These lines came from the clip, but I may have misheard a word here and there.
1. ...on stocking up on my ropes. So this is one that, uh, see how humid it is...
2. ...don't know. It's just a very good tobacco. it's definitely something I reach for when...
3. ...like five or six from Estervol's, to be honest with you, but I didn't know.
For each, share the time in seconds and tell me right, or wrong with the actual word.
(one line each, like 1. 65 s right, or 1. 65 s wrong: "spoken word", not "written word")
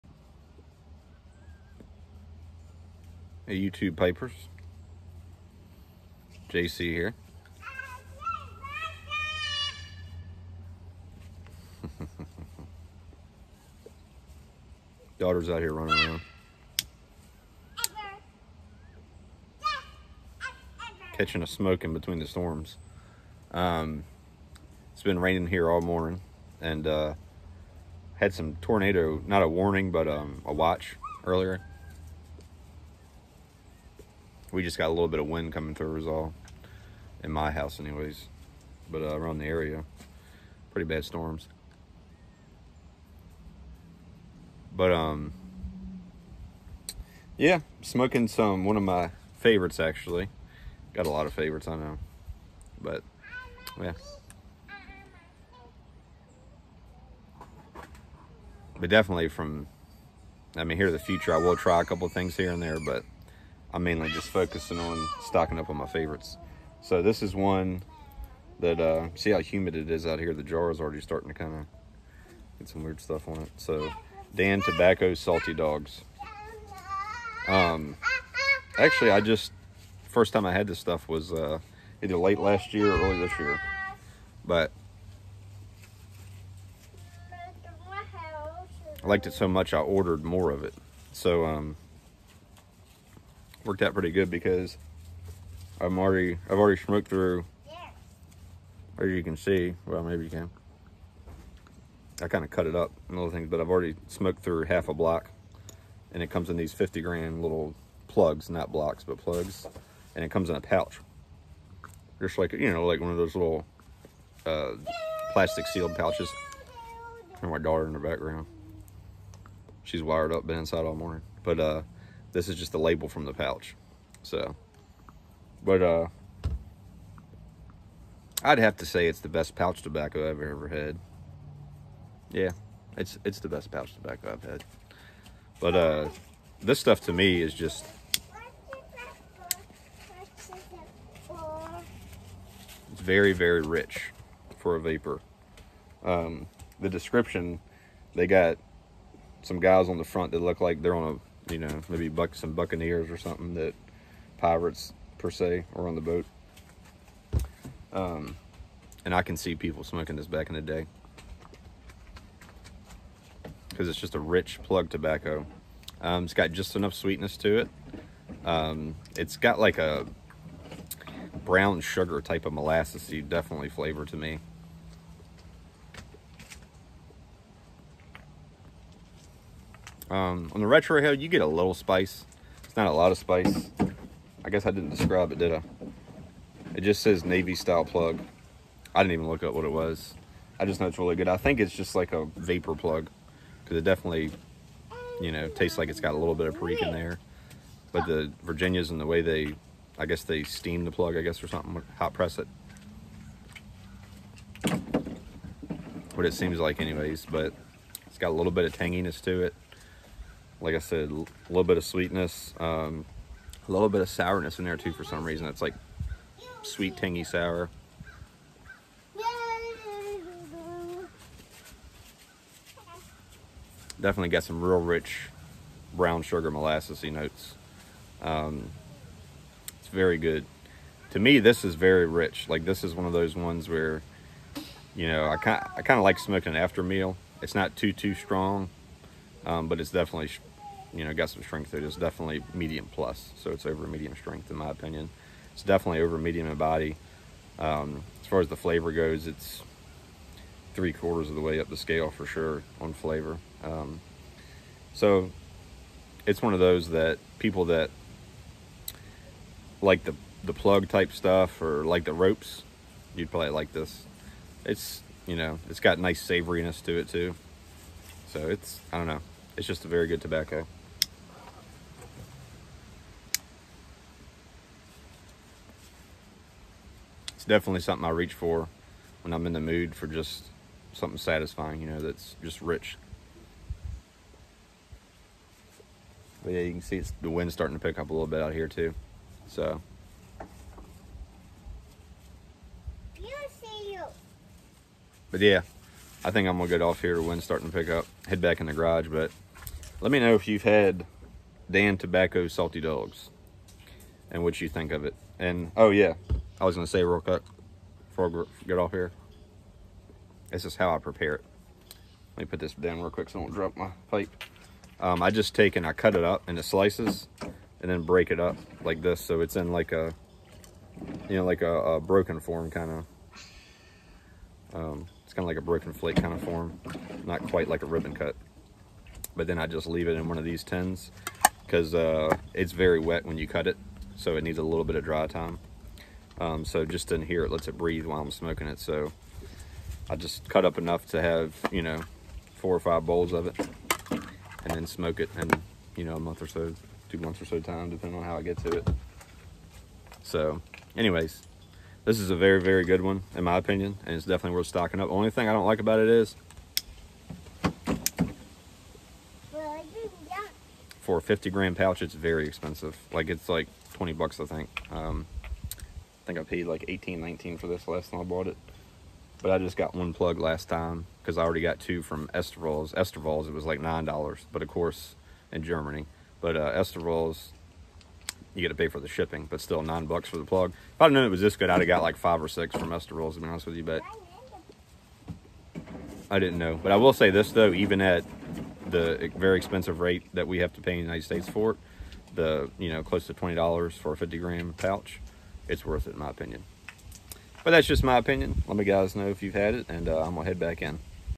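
1. 64 s wrong: "favorites", not "ropes"
2. 268 s right
3. 382 s right.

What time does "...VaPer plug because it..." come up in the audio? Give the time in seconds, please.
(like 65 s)
192 s.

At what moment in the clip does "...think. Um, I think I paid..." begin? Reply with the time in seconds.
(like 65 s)
364 s.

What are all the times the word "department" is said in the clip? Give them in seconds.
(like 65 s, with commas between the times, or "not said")
not said.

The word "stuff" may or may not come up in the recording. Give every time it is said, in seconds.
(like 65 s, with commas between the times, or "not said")
72 s, 80 s, 136 s, 261 s.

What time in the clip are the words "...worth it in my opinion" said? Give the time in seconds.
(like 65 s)
395 s.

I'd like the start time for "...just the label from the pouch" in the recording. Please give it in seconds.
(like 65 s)
122 s.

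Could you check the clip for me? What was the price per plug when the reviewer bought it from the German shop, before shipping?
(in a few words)
$9.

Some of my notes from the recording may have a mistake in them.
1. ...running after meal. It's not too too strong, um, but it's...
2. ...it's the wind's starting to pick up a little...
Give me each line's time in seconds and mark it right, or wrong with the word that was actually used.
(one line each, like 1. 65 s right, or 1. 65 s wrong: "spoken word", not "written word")
1. 236 s wrong: "smoking", not "running"
2. 286 s right.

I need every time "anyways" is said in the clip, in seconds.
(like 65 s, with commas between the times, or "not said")
37 s, 206 s, 350 s.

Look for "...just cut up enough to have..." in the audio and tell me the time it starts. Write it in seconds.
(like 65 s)
340 s.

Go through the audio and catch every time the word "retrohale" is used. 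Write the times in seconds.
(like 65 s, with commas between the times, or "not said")
180 s.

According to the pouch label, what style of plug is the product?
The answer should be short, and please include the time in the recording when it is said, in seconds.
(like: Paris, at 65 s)
Navy style plug, at 187 s.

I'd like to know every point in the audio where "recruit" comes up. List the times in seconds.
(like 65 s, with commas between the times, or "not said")
not said.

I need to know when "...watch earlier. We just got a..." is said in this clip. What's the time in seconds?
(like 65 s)
30 s.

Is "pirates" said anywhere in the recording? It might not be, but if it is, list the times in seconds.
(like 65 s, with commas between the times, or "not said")
154 s.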